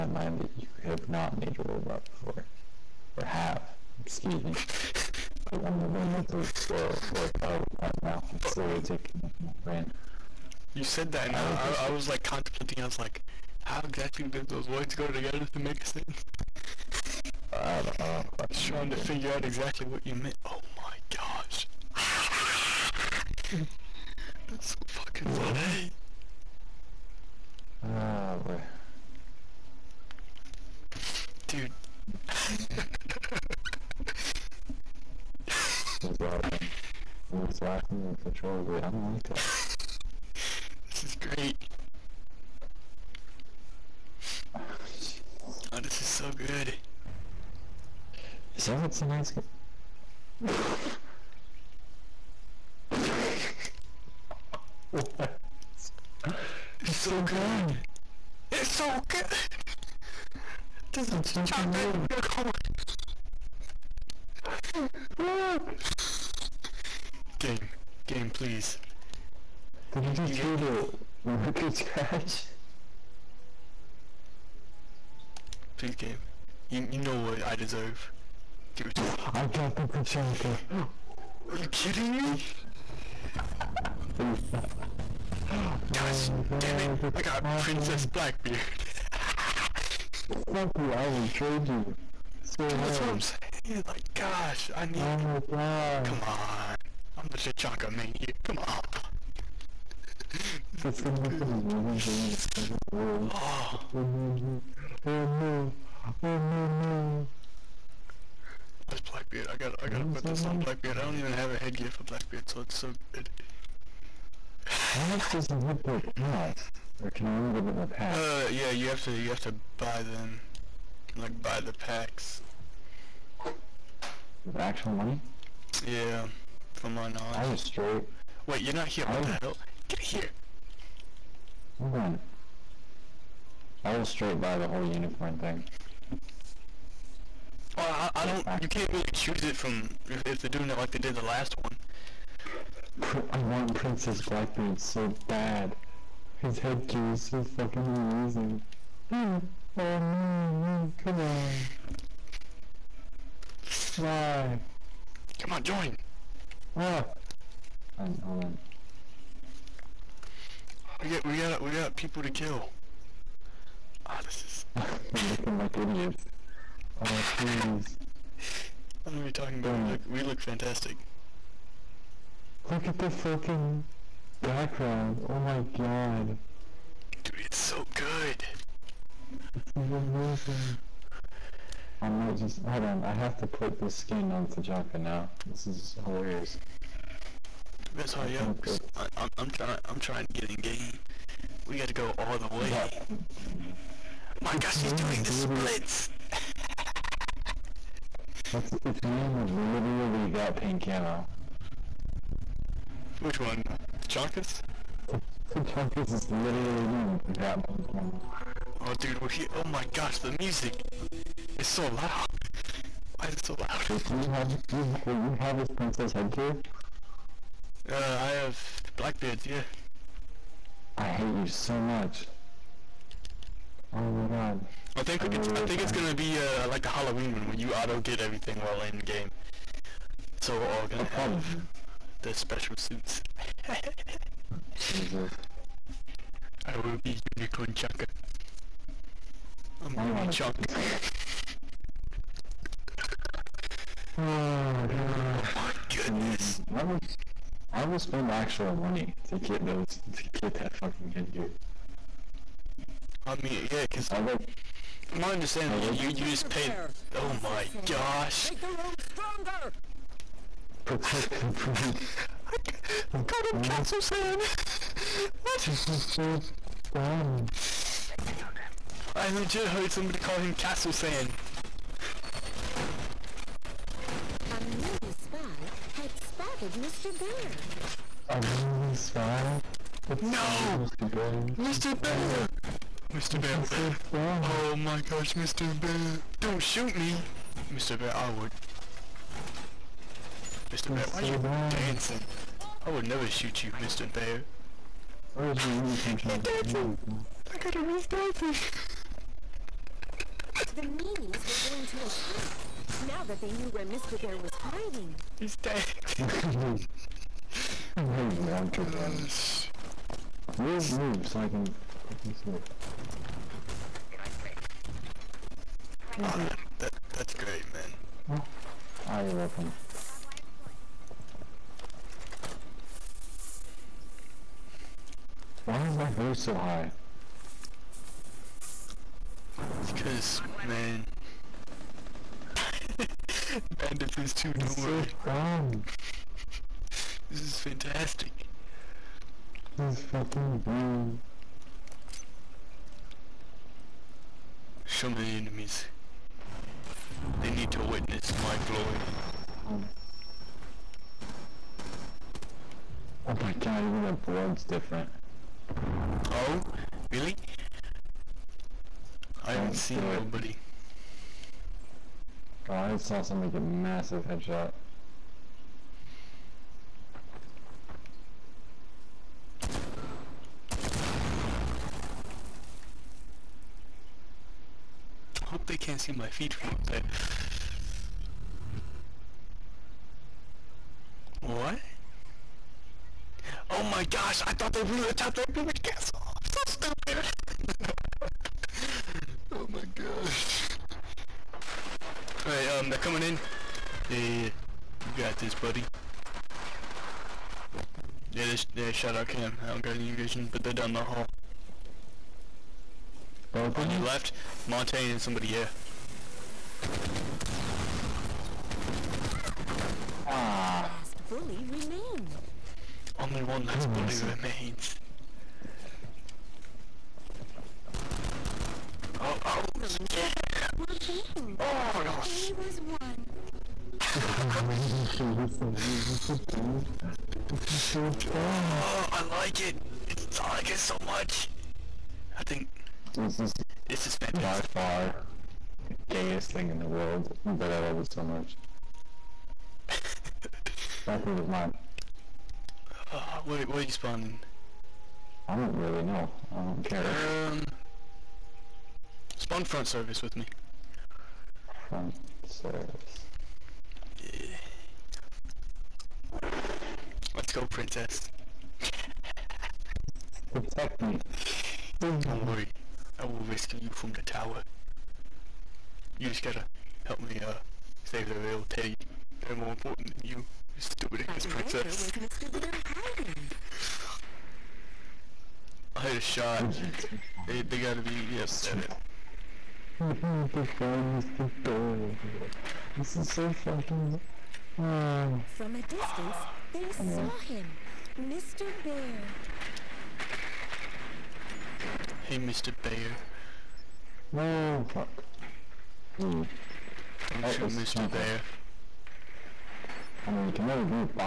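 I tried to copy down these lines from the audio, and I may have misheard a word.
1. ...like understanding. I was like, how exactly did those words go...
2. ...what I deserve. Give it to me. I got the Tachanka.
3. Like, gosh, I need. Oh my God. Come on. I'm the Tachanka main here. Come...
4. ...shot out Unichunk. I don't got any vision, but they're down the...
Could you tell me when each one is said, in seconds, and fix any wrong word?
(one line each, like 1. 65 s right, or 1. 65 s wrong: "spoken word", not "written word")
1. 12 s wrong: "contemplating", not "understanding"
2. 77 s right
3. 93 s right
4. 398 s wrong: "Cam", not "Unichunk".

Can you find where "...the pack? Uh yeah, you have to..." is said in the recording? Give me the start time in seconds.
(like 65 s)
117 s.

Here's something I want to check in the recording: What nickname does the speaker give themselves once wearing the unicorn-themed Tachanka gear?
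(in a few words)
Unichunk.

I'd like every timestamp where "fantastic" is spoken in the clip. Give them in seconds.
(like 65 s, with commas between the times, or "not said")
170 s, 337 s, 434 s.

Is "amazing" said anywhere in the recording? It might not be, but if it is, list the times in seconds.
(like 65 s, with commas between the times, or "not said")
101 s, 147 s, 179 s.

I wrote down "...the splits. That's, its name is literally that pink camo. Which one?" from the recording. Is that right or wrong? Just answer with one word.
right.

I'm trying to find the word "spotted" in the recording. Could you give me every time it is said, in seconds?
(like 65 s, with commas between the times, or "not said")
276 s.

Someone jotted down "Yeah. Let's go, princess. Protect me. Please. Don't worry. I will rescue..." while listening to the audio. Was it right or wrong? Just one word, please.
right.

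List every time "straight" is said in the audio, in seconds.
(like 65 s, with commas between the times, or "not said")
127 s, 134 s.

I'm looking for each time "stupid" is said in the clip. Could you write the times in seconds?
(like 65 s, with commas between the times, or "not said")
386 s, 470 s.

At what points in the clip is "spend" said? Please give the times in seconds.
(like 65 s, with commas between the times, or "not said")
247 s.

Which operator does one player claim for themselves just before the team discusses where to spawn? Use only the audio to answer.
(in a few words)
Valkyrie.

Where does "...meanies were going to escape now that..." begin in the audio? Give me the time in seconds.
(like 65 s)
300 s.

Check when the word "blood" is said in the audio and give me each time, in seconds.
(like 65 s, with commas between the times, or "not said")
354 s.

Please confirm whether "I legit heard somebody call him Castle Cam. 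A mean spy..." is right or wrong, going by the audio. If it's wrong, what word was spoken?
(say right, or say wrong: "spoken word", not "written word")
wrong: "Sand", not "Cam".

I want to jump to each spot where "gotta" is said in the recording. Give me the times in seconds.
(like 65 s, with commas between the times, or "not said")
109 s, 466 s, 477 s.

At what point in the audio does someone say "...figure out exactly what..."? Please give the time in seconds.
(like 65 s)
18 s.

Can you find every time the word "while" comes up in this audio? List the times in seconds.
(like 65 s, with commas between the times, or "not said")
228 s.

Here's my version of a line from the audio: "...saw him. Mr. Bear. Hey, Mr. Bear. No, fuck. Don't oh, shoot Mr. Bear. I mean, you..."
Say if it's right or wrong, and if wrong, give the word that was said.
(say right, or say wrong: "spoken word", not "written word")
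right.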